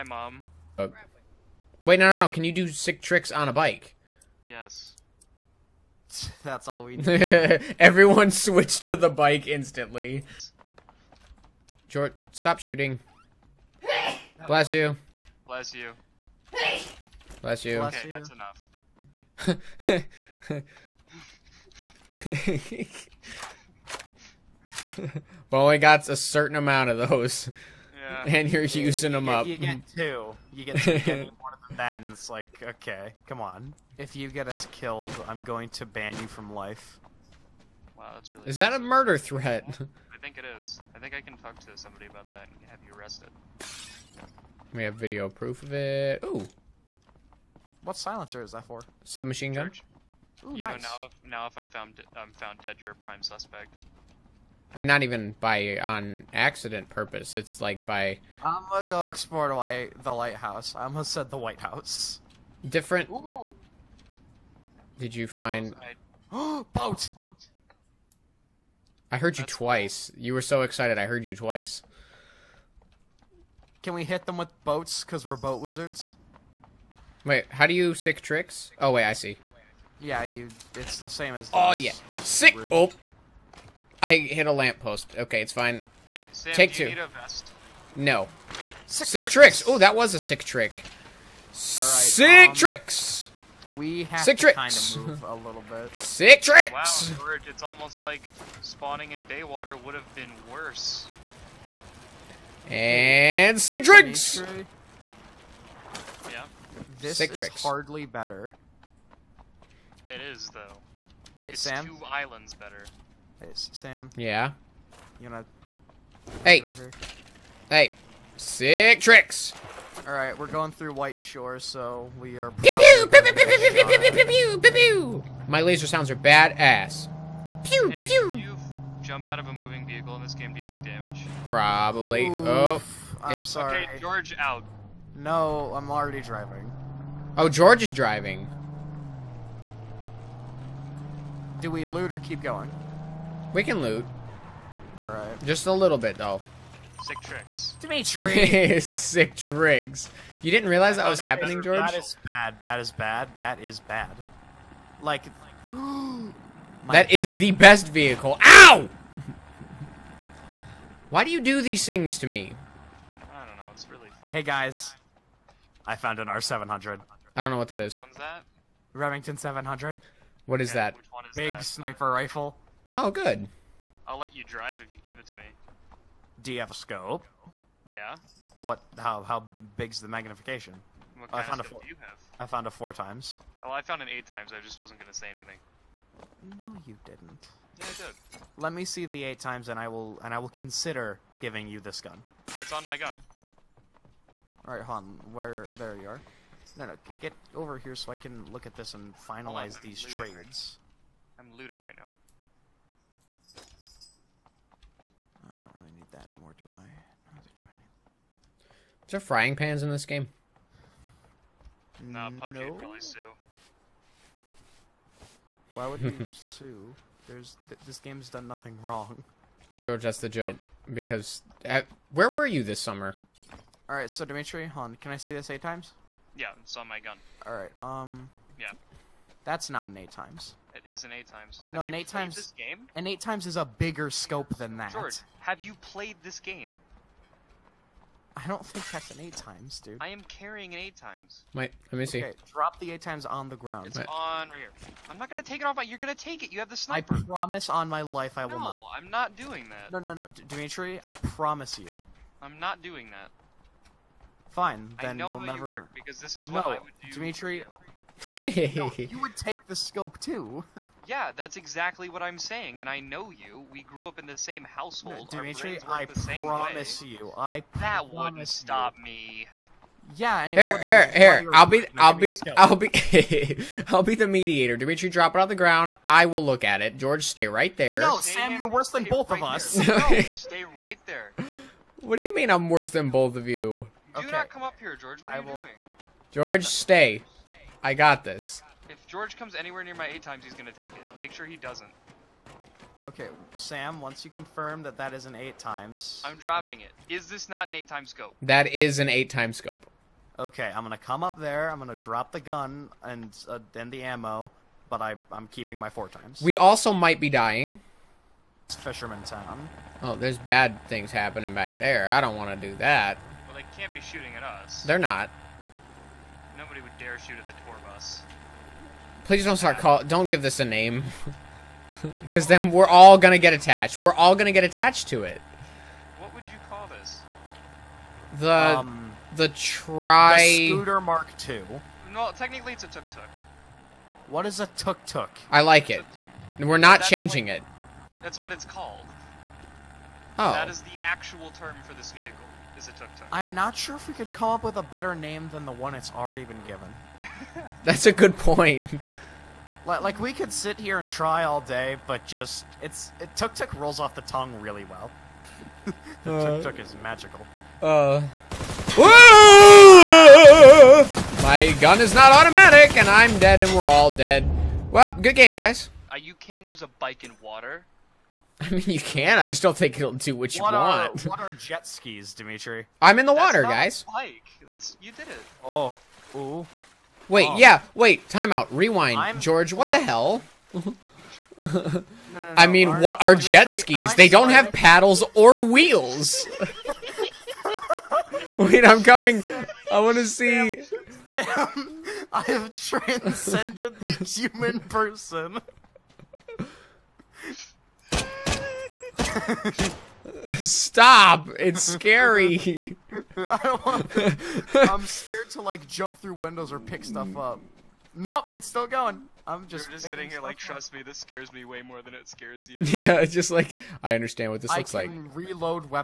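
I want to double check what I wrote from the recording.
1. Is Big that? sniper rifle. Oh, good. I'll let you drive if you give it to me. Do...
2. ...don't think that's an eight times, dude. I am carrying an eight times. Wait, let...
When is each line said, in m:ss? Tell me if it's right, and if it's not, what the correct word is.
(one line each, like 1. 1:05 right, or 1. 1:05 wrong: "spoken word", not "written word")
1. 2:51 right
2. 3:58 right.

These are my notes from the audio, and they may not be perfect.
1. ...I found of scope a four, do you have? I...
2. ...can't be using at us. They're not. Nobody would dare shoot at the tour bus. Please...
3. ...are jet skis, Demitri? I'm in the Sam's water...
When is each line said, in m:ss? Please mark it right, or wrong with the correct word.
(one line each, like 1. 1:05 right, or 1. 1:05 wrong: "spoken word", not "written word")
1. 3:01 right
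2. 5:13 wrong: "shooting", not "using"
3. 6:11 wrong: "That", not "Sam".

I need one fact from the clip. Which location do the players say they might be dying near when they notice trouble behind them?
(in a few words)
Fisherman Town.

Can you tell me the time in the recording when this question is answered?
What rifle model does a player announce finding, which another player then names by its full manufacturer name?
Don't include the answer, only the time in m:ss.
2:46.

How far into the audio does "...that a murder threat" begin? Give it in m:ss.
0:38.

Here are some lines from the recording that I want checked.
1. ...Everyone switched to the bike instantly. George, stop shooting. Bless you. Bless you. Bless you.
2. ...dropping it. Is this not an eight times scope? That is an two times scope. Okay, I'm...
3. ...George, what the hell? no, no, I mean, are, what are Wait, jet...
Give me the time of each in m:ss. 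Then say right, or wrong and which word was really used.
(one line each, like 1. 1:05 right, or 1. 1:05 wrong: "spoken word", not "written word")
1. 0:07 right
2. 4:56 wrong: "eight", not "two"
3. 6:19 wrong: "Demitri", not "Wait".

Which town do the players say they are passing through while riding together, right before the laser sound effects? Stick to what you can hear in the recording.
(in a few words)
White Shore.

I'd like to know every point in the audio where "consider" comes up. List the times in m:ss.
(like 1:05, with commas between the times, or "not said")
3:10.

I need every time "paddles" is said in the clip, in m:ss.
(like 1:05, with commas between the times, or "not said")
6:24.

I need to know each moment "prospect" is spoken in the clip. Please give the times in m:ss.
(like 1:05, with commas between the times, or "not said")
not said.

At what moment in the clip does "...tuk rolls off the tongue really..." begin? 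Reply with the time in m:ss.
5:53.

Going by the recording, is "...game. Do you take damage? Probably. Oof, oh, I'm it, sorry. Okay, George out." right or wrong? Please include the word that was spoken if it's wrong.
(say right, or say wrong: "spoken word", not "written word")
right.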